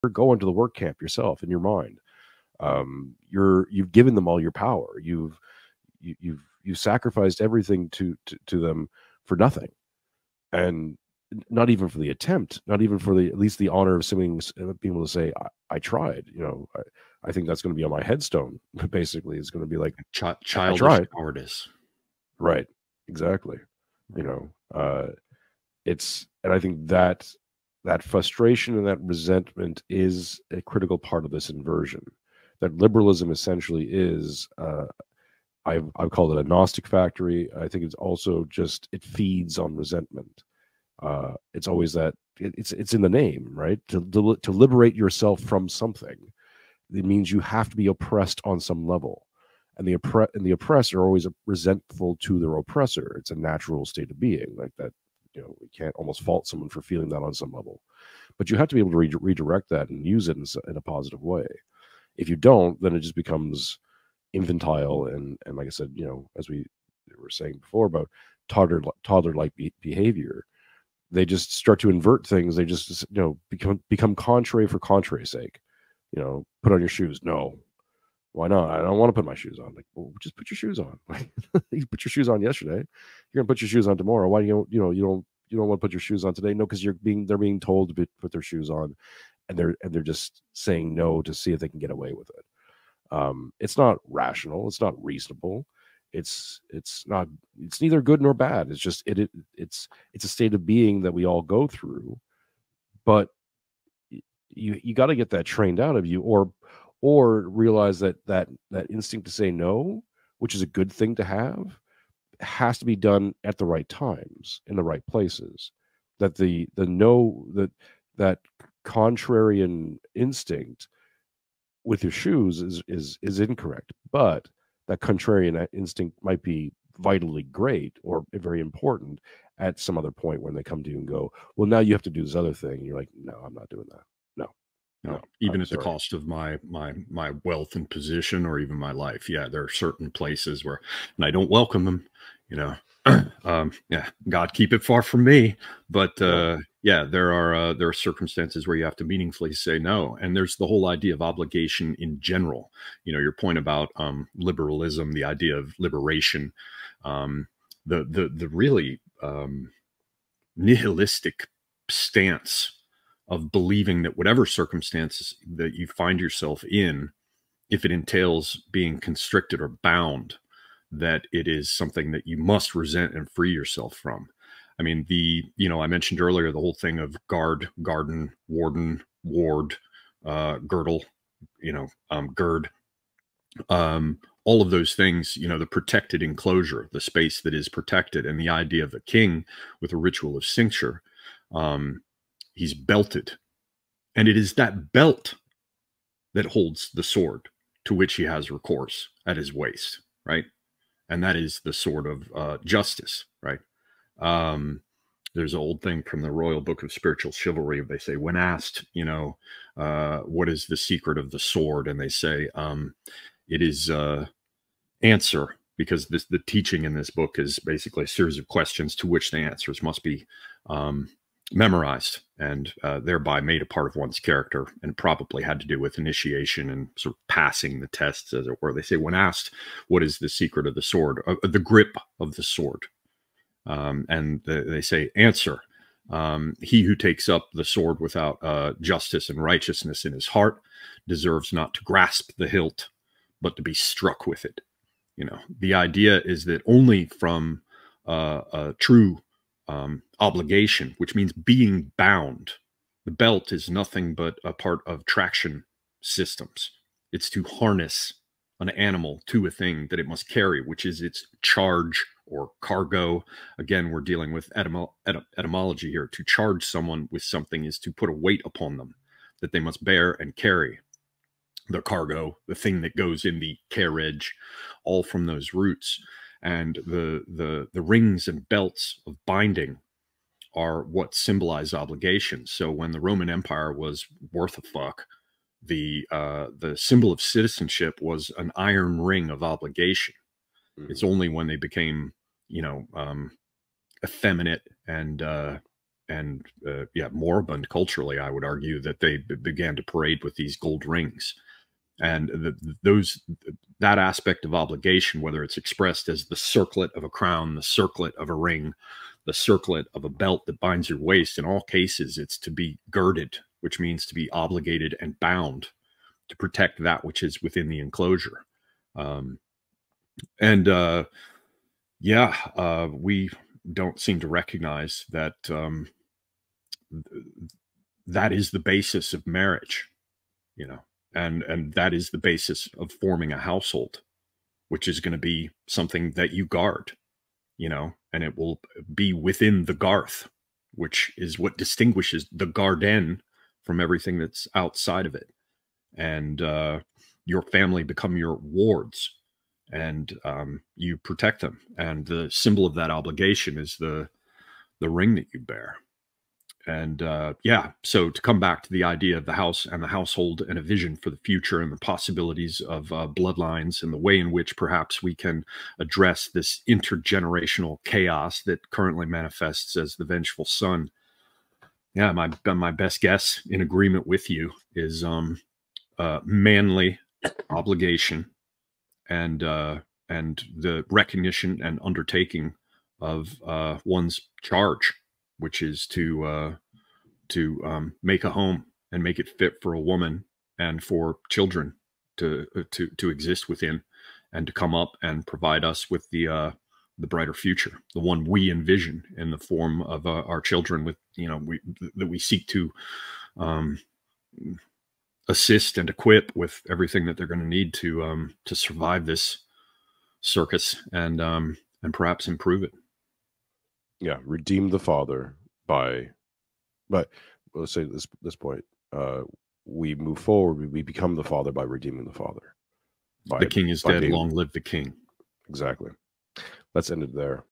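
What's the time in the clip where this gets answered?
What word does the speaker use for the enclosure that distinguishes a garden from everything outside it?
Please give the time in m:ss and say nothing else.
5:39.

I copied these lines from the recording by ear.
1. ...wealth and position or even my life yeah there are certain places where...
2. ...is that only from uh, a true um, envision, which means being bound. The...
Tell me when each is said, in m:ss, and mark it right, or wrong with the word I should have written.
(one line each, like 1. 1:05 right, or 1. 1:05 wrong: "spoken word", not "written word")
1. 2:17 right
2. 4:06 wrong: "obligation", not "envision".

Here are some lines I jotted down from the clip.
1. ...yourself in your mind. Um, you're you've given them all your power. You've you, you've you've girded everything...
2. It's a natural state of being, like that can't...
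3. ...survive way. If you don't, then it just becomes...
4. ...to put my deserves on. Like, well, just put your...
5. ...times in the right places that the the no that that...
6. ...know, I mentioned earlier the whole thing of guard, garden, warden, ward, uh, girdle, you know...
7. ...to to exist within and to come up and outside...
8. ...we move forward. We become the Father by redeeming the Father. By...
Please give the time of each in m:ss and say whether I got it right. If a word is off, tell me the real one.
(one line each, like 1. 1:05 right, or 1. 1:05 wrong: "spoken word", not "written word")
1. 0:01 wrong: "sacrificed", not "girded"
2. 0:53 right
3. 1:00 wrong: "positive", not "survive"
4. 1:19 wrong: "shoes", not "deserves"
5. 1:53 right
6. 2:55 right
7. 6:32 wrong: "provide", not "outside"
8. 6:59 right.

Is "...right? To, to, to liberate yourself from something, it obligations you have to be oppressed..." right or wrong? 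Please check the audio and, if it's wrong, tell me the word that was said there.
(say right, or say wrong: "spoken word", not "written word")
wrong: "means", not "obligations".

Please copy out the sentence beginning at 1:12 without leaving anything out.
They just you know become become contrary for contrary sake.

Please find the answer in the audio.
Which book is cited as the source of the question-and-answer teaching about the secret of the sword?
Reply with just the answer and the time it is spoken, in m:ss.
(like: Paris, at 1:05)
Royal Book of Spiritual Chivalry, at 3:26.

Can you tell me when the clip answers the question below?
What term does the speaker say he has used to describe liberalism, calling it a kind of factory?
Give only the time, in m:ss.
0:36.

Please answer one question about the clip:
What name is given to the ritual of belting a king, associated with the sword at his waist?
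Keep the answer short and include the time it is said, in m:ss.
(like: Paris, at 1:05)
Cincture, at 3:10.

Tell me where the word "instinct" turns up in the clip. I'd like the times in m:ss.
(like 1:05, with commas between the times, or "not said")
1:48, 2:00, 2:05.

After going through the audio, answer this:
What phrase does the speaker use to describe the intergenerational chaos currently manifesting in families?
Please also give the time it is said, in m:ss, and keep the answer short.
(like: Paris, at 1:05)
The vengeful son, at 6:10.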